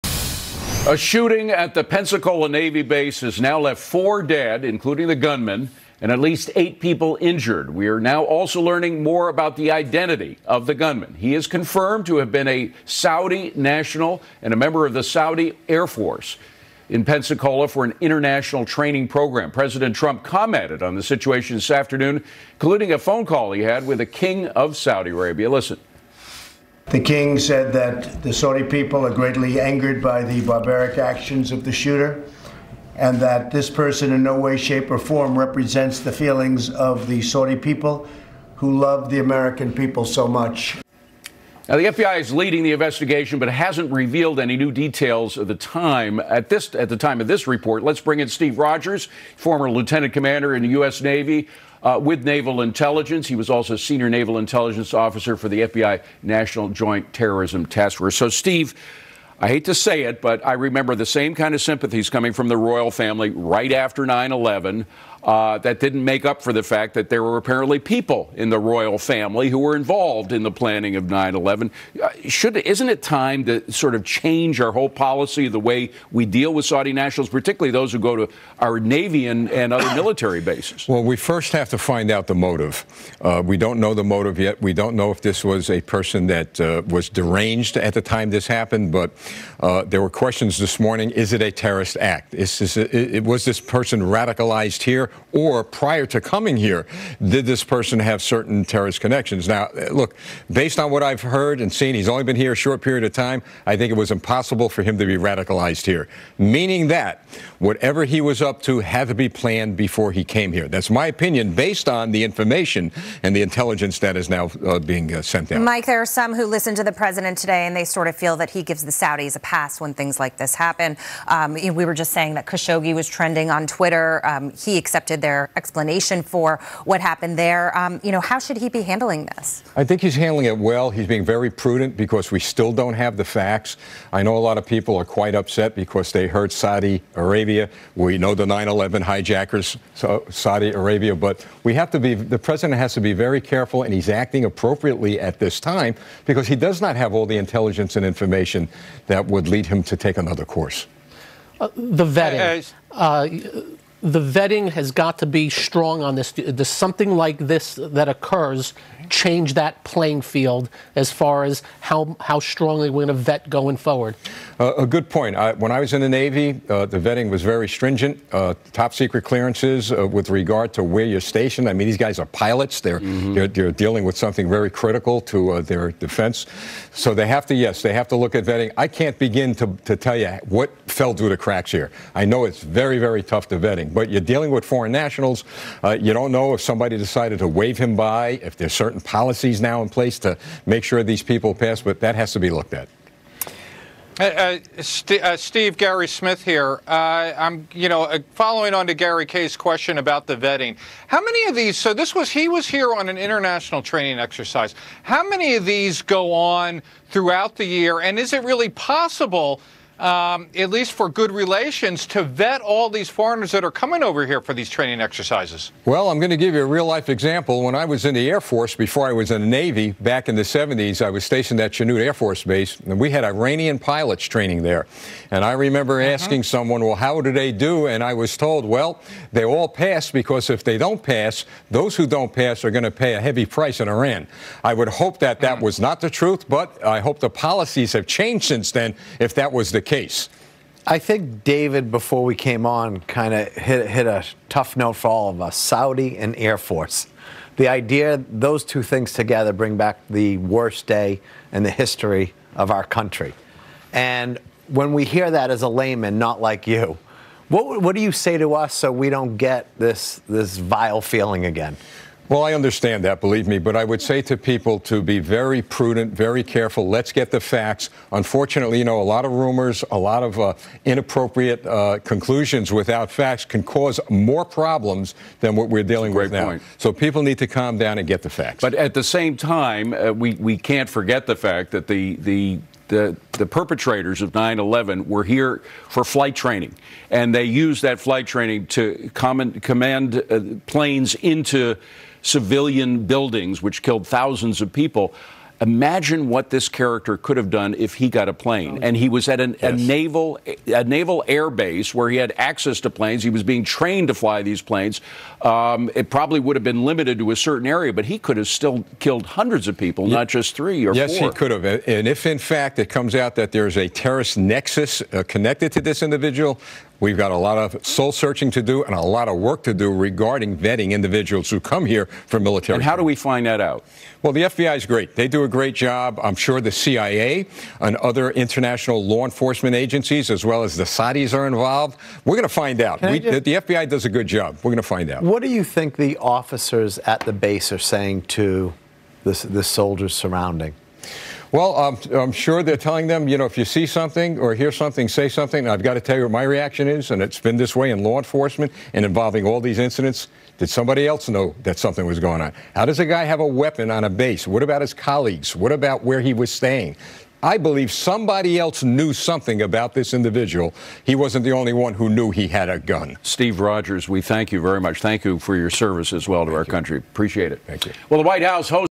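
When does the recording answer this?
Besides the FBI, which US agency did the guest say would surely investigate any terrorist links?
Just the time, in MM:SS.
05:26.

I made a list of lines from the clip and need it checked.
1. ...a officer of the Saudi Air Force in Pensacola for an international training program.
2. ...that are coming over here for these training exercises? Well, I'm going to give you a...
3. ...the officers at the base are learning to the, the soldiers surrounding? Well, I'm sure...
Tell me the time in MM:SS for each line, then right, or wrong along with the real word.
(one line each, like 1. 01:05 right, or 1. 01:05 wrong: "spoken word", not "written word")
1. 00:14 wrong: "member", not "officer"
2. 03:33 right
3. 05:35 wrong: "saying", not "learning".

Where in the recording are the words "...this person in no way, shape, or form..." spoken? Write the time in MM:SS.
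00:33.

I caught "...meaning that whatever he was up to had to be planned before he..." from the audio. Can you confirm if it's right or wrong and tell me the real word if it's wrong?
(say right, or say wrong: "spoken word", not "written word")
right.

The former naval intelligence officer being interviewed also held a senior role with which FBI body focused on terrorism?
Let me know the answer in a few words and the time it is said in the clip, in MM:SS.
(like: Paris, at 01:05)
National Joint Terrorism Task Force, at 00:56.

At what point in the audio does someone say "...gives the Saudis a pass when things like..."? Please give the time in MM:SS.
01:58.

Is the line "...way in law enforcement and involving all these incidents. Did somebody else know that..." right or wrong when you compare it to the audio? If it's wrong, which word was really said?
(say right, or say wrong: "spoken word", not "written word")
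right.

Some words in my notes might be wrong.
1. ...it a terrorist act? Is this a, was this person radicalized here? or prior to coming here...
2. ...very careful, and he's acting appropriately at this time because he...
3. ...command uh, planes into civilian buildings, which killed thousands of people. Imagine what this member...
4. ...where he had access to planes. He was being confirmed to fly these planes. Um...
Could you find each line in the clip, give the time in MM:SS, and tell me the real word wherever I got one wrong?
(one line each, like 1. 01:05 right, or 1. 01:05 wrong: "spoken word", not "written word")
1. 01:31 right
2. 02:23 right
3. 04:49 wrong: "character", not "member"
4. 05:01 wrong: "trained", not "confirmed".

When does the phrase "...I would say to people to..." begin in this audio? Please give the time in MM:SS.
04:23.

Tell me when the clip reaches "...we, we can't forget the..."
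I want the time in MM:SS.
04:40.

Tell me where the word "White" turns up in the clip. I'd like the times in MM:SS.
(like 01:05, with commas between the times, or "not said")
06:08.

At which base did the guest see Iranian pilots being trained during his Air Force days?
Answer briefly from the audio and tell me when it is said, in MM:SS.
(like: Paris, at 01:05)
Chanute Air Force Base, at 03:41.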